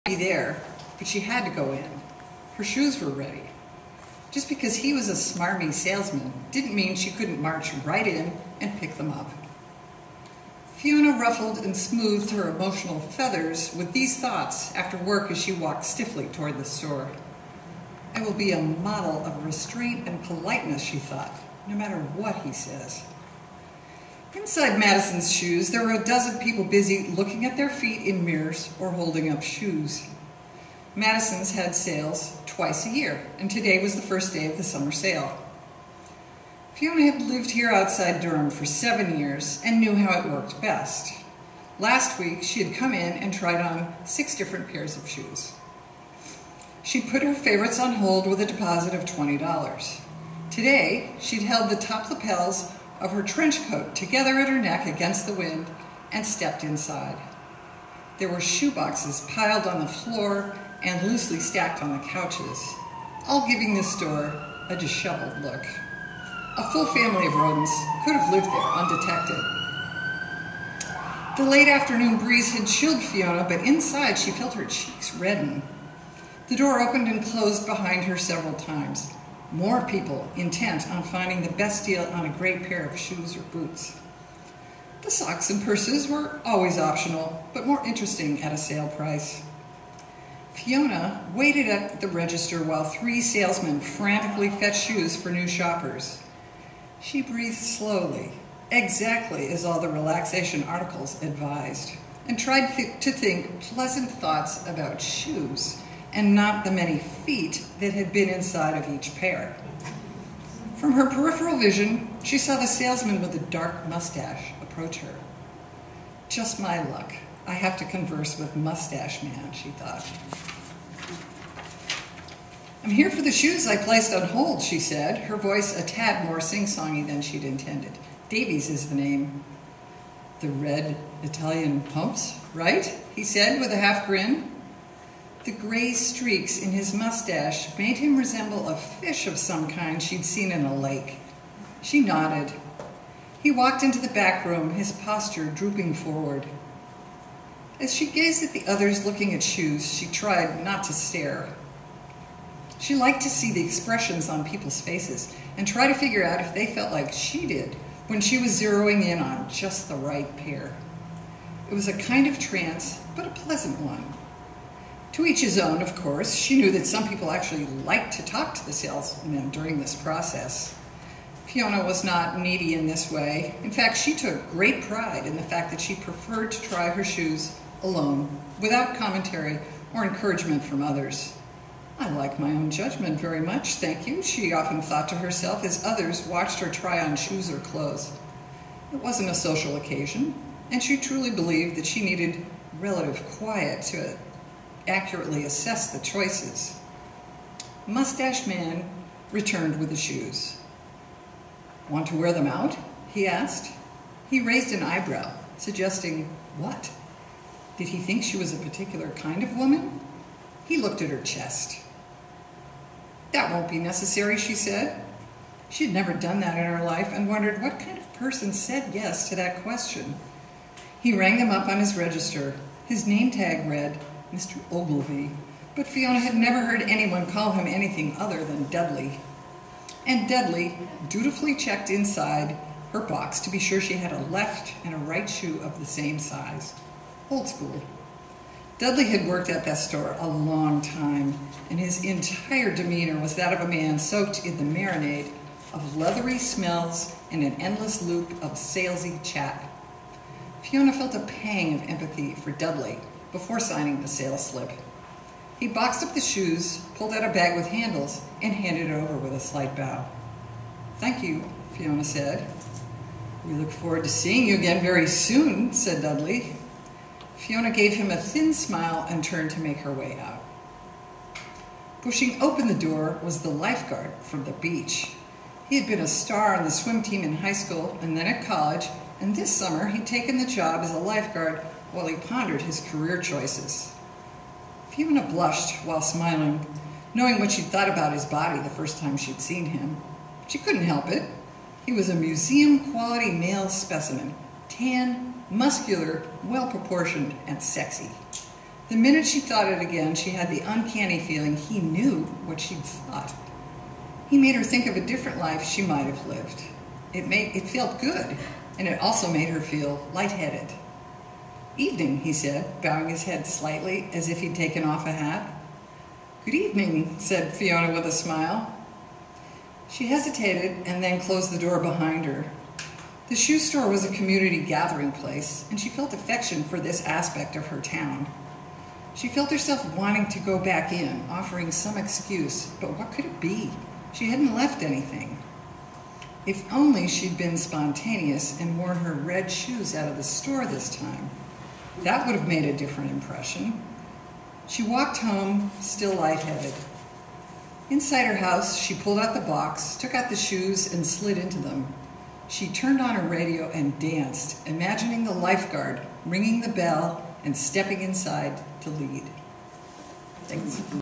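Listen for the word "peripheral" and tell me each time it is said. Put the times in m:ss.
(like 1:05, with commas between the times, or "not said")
1:51.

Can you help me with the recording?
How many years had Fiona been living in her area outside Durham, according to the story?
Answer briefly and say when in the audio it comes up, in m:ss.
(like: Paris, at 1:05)
7, at 0:38.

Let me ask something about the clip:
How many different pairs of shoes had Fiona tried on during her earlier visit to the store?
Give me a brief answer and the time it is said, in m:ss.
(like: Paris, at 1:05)
6, at 0:44.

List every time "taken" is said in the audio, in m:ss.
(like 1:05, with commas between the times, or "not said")
4:40, 5:14.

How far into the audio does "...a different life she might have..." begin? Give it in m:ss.
5:04.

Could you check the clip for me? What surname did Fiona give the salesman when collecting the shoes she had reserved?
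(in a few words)
Davies.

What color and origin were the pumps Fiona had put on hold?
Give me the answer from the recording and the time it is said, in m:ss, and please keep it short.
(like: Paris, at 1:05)
Red Italian, at 2:10.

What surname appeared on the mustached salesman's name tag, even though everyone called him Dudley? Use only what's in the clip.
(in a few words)
Ogilvy.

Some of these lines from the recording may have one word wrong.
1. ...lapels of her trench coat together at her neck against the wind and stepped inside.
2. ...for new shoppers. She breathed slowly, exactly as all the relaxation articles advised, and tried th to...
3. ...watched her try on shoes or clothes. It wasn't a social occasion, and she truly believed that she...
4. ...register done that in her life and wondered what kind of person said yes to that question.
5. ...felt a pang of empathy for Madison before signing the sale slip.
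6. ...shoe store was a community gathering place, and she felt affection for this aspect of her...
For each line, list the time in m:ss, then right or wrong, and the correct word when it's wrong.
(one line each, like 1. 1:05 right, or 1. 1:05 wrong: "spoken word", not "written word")
1. 0:52 right
2. 1:35 right
3. 3:06 right
4. 3:35 wrong: "never", not "register"
5. 4:10 wrong: "Dudley", not "Madison"
6. 5:23 right.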